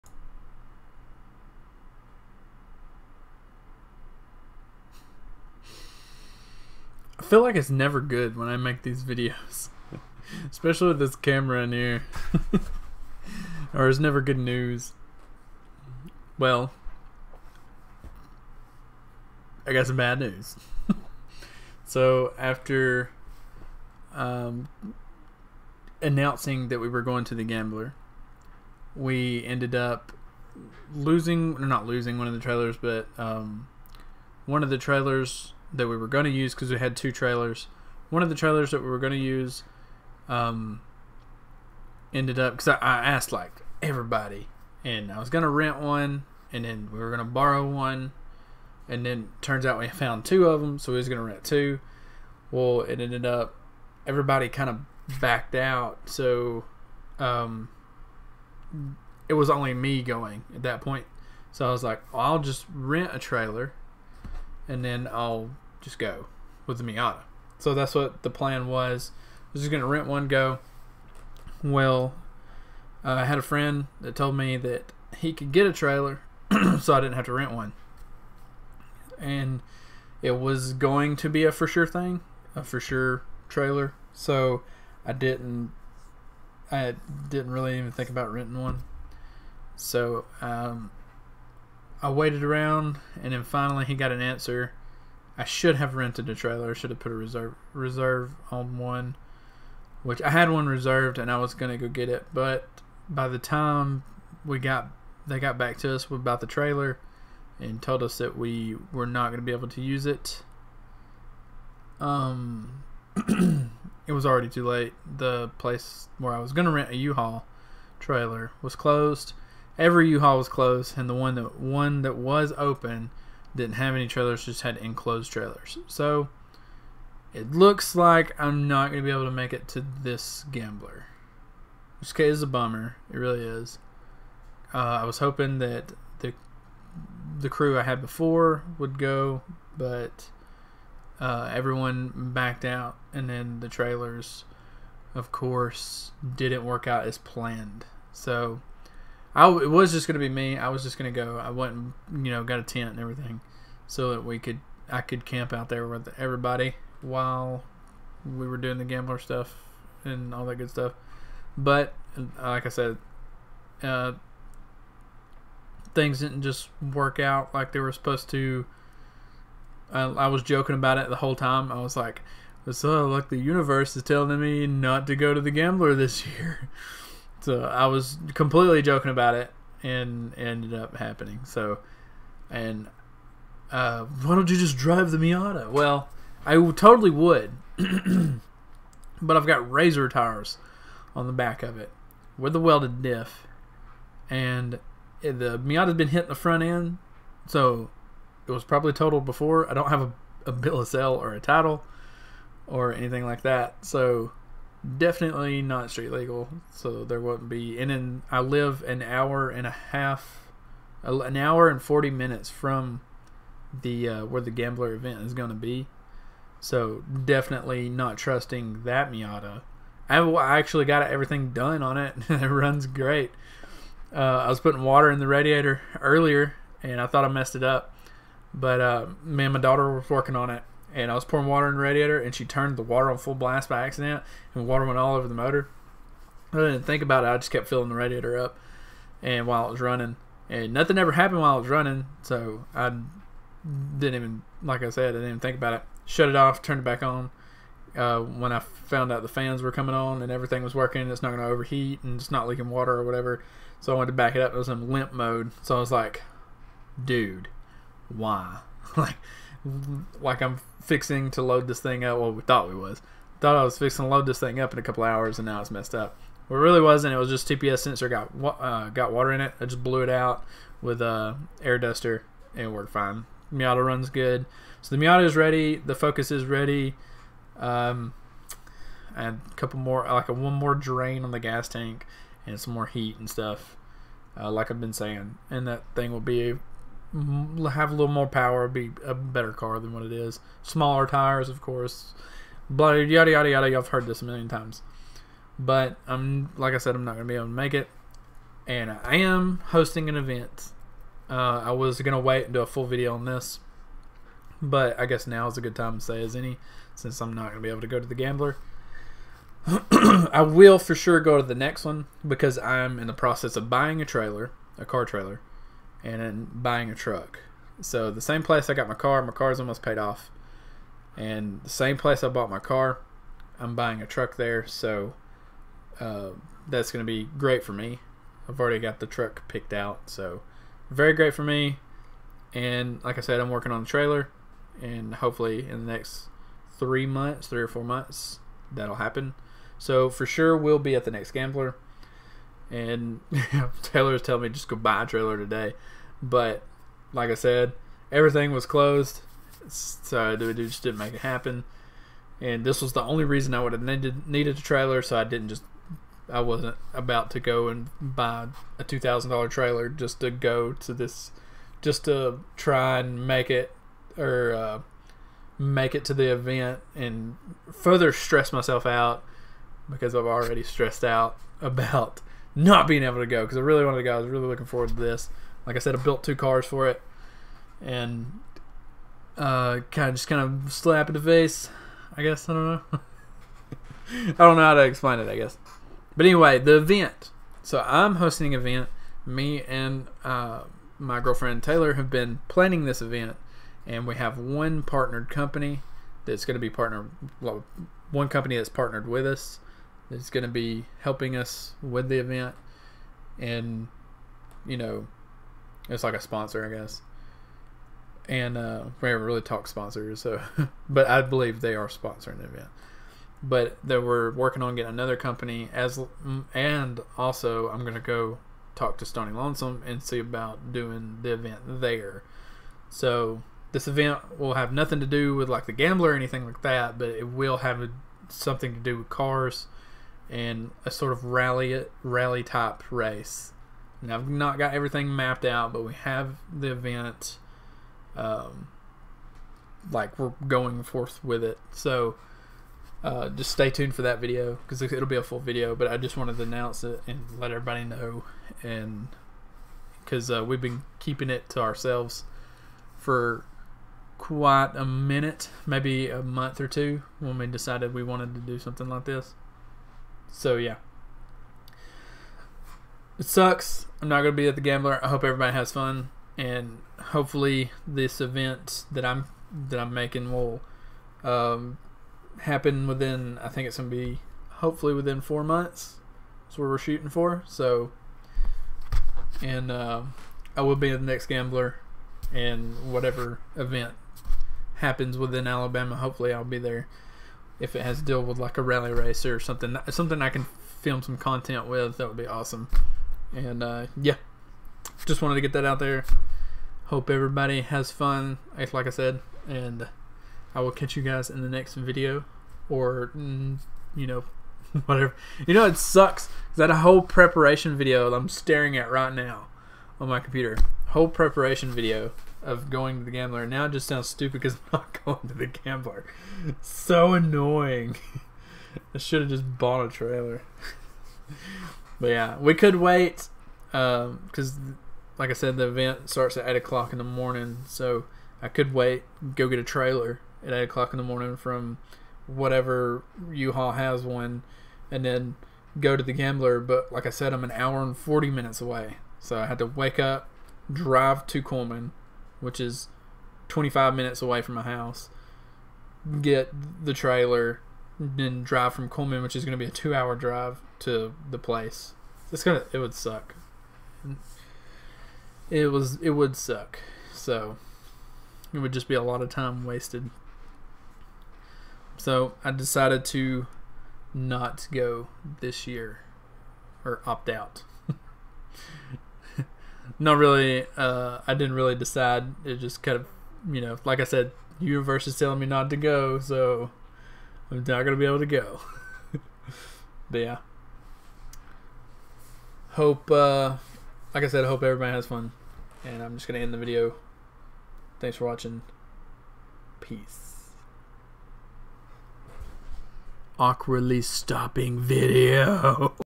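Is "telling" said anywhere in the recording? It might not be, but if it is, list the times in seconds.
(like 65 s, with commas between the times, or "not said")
174 s, 344 s, 575 s.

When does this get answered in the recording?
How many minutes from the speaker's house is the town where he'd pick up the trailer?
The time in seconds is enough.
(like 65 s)
543 s.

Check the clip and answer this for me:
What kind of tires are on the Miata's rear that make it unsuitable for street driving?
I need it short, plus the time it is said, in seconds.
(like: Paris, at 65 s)
razor tires, at 189 s.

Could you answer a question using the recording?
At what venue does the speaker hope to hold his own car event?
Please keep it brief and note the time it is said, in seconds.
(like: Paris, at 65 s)
Stony Lonesome, at 419 s.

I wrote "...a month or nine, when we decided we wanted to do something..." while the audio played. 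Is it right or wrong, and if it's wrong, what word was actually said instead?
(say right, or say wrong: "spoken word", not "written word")
wrong: "two", not "nine".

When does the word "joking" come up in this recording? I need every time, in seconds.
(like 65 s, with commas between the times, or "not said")
170 s, 178 s.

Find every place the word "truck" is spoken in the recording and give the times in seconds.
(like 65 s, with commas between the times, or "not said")
316 s, 324 s, 329 s.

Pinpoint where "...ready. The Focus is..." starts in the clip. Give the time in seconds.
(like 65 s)
275 s.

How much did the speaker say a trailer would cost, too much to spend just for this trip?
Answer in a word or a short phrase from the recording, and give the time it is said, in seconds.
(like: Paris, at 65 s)
$2,000, at 358 s.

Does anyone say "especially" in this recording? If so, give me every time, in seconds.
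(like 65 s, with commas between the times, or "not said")
10 s.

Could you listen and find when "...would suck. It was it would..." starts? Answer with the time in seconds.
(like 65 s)
552 s.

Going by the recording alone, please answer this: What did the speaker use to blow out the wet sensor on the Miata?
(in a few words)
air duster.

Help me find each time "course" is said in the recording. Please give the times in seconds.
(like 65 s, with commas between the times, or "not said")
145 s, 291 s.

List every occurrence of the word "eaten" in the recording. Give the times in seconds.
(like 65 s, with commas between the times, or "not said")
not said.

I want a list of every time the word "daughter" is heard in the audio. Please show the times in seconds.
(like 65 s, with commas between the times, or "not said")
229 s.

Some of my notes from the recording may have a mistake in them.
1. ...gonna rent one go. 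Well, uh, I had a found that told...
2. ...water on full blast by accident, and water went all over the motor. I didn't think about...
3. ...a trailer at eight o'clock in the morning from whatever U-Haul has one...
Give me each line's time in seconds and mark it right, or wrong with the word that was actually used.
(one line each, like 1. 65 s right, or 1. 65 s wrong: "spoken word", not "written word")
1. 69 s wrong: "friend", not "found"
2. 232 s right
3. 529 s right.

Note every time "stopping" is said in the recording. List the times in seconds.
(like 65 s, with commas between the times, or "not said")
594 s.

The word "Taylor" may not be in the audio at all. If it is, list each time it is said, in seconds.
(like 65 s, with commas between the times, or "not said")
343 s, 391 s.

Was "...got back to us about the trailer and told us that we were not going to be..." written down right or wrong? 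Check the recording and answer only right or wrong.
right.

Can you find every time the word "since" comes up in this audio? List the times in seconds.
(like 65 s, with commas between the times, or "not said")
306 s.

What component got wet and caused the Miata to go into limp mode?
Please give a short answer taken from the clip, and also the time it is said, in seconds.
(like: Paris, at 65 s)
TPS sensor, at 267 s.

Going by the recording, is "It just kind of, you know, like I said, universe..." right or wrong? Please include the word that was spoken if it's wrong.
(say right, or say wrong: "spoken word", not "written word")
right.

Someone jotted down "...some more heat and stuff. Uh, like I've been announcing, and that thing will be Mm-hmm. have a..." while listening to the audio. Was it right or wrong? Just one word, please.
wrong.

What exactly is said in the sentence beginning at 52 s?
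Well, it ended up everybody kind of backed out, so um, it was only me going at that point.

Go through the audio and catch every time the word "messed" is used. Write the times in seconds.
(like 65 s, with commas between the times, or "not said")
227 s, 265 s.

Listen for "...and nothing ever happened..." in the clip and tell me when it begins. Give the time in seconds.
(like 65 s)
240 s.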